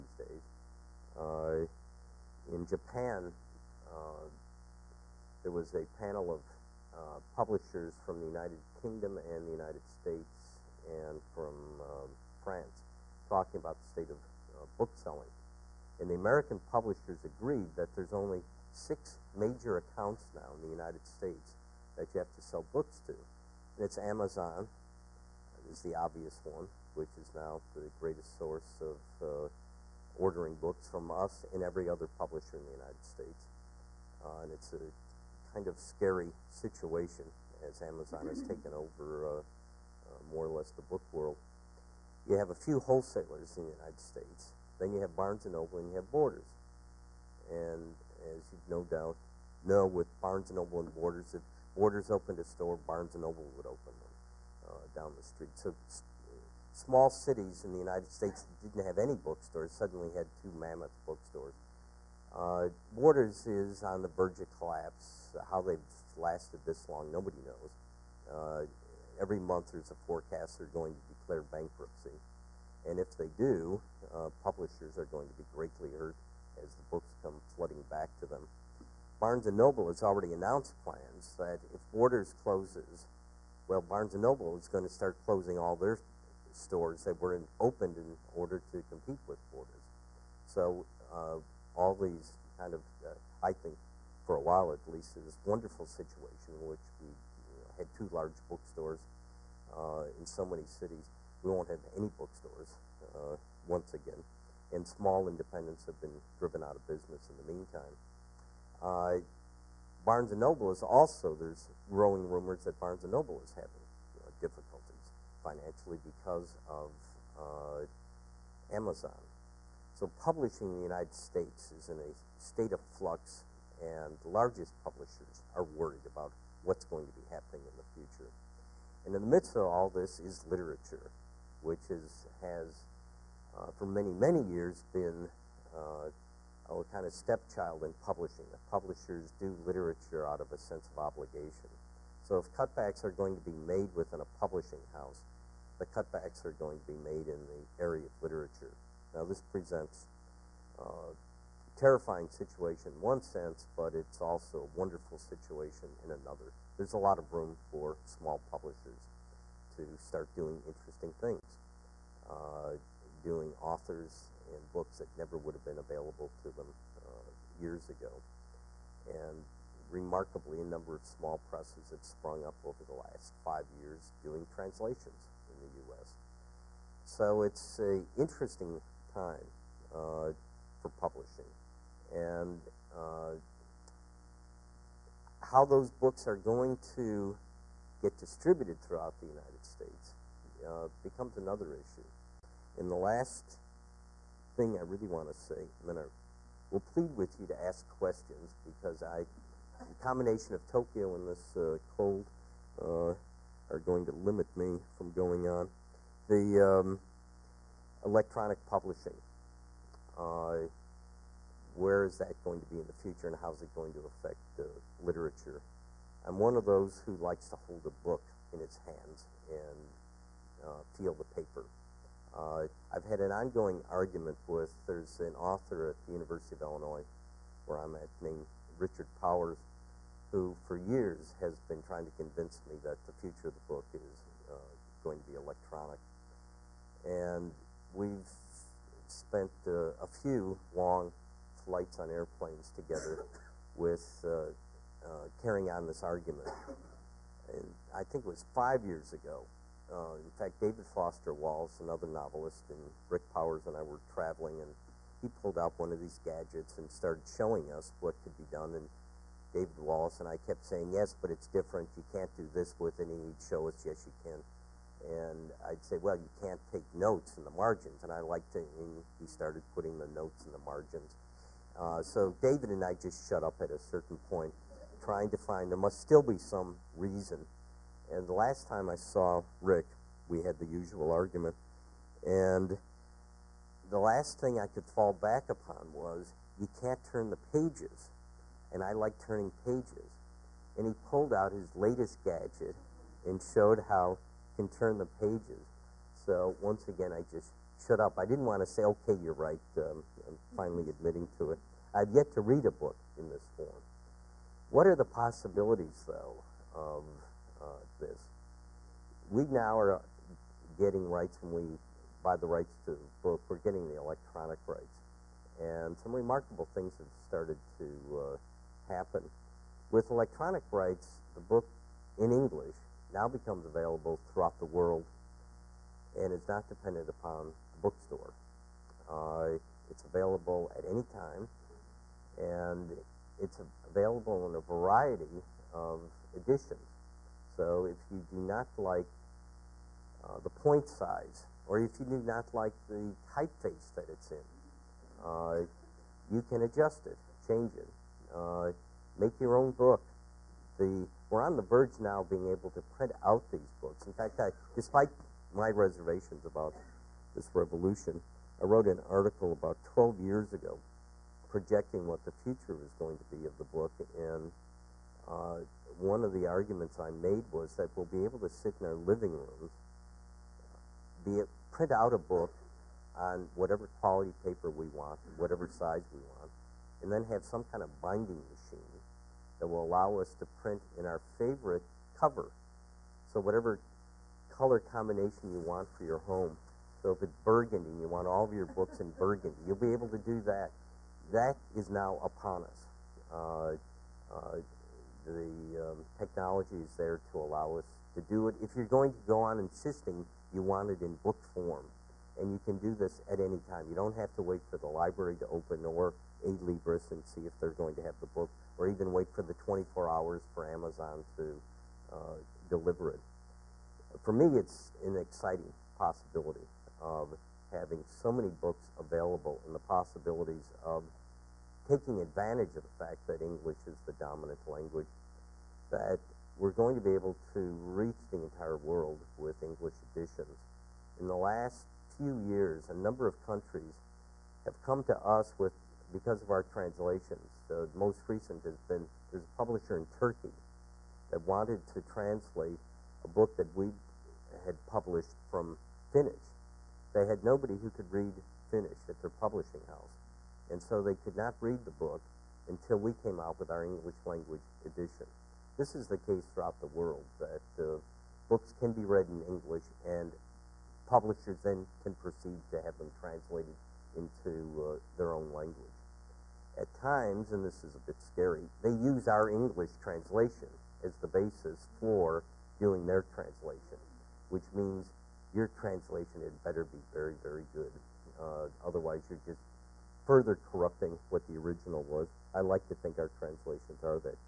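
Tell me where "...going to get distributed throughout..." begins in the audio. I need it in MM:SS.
03:06.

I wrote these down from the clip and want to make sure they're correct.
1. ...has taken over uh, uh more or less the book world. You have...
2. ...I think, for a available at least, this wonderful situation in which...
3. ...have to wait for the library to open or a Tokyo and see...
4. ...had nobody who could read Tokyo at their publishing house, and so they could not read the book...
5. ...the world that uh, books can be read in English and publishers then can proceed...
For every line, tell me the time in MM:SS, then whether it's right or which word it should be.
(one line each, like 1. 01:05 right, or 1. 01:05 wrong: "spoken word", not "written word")
1. 00:38 right
2. 01:33 wrong: "while", not "available"
3. 06:44 wrong: "Libris", not "Tokyo"
4. 07:27 wrong: "Finnish", not "Tokyo"
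5. 07:36 right.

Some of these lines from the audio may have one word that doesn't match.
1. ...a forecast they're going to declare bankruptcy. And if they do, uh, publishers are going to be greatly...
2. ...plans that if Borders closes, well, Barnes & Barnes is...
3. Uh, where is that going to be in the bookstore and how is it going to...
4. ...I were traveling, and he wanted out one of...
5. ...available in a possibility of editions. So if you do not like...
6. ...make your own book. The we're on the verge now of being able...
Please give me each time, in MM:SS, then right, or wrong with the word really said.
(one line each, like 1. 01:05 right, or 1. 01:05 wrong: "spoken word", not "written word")
1. 01:09 right
2. 01:20 wrong: "Noble", not "Barnes"
3. 03:30 wrong: "future", not "bookstore"
4. 04:13 wrong: "pulled", not "wanted"
5. 05:33 wrong: "variety", not "possibility"
6. 05:49 right.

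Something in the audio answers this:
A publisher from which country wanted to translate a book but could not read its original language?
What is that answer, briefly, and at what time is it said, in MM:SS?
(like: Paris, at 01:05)
Turkey, at 07:20.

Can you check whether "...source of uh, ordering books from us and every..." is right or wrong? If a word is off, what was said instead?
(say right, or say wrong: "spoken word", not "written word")
right.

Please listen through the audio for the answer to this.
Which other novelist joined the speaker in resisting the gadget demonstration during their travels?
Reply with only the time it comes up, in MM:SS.
04:10.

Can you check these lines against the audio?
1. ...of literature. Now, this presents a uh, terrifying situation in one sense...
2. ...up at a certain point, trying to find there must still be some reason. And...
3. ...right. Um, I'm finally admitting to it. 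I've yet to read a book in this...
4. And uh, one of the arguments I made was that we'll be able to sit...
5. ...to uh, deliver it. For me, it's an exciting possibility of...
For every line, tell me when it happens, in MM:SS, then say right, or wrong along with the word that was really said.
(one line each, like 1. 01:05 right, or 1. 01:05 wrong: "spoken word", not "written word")
1. 02:28 right
2. 04:33 right
3. 04:59 right
4. 06:04 right
5. 06:51 right.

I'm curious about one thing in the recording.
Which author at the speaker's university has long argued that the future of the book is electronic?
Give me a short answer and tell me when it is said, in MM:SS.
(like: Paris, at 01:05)
Richard Powers, at 03:48.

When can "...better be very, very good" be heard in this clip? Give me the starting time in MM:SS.
07:56.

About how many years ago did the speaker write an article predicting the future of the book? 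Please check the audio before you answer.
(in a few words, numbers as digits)
12 years.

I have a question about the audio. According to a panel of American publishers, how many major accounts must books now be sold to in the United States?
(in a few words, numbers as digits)
6.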